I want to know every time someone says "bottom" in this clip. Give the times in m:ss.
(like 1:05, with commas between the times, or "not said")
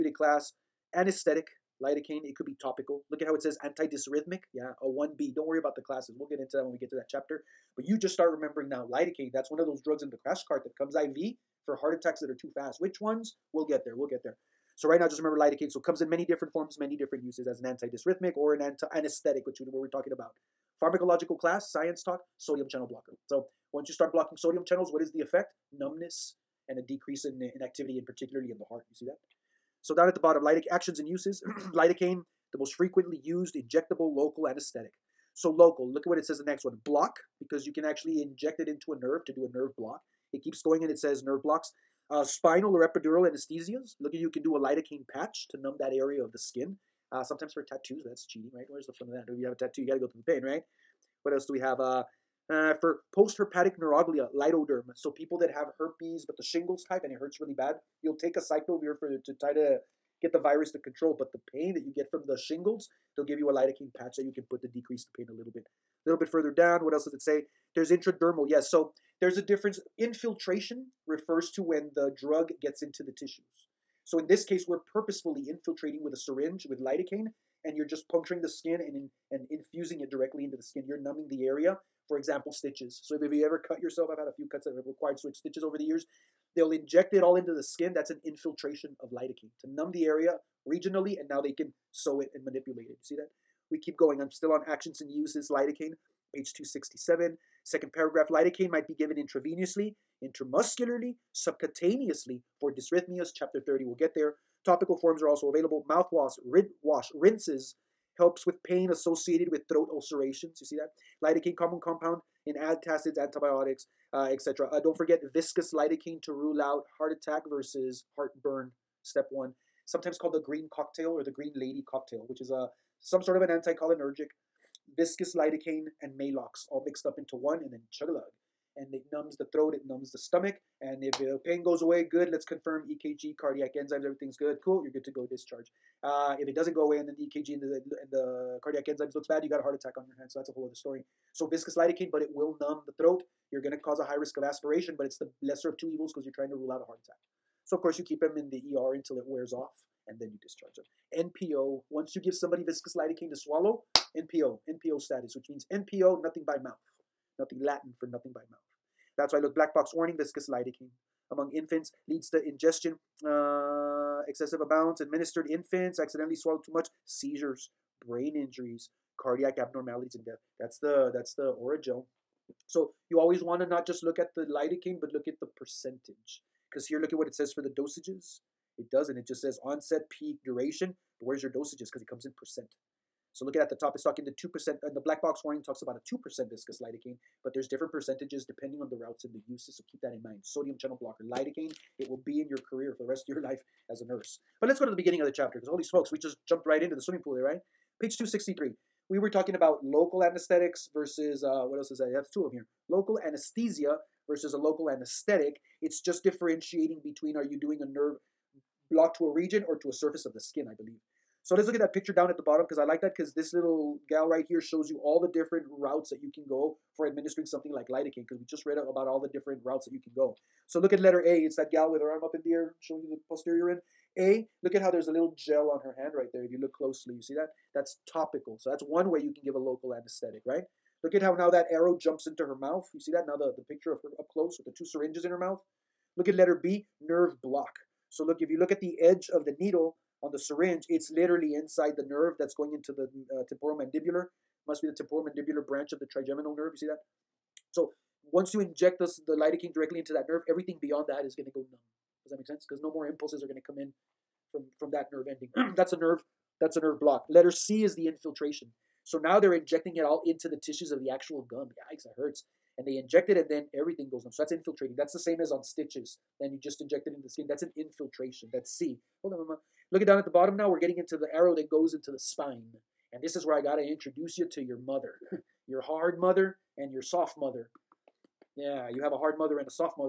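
0:30, 3:32, 4:30.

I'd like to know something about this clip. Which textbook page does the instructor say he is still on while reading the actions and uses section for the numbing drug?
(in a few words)
267.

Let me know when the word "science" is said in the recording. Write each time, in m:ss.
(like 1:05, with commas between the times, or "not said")
0:21.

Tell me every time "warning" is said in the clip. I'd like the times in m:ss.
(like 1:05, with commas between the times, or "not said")
2:39, 3:05.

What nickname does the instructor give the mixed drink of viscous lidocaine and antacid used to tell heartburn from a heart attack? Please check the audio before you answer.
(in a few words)
green lady cocktail.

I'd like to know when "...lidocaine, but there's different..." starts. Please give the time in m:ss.
3:06.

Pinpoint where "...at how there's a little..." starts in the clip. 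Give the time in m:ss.
3:44.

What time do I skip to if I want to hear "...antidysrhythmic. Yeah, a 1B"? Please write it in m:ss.
0:03.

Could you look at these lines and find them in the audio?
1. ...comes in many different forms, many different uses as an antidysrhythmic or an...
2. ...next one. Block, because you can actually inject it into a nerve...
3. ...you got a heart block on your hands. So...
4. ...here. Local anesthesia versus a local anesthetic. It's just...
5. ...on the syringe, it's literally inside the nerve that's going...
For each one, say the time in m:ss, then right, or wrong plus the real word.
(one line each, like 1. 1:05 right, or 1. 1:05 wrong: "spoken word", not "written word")
1. 0:15 right
2. 0:36 right
3. 2:19 wrong: "attack", not "block"
4. 3:22 right
5. 4:00 right.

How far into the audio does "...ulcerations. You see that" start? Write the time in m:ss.
1:49.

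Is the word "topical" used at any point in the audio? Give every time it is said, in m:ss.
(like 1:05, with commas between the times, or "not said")
0:02, 1:44, 3:48.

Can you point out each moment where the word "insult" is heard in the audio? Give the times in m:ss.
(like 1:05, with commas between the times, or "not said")
not said.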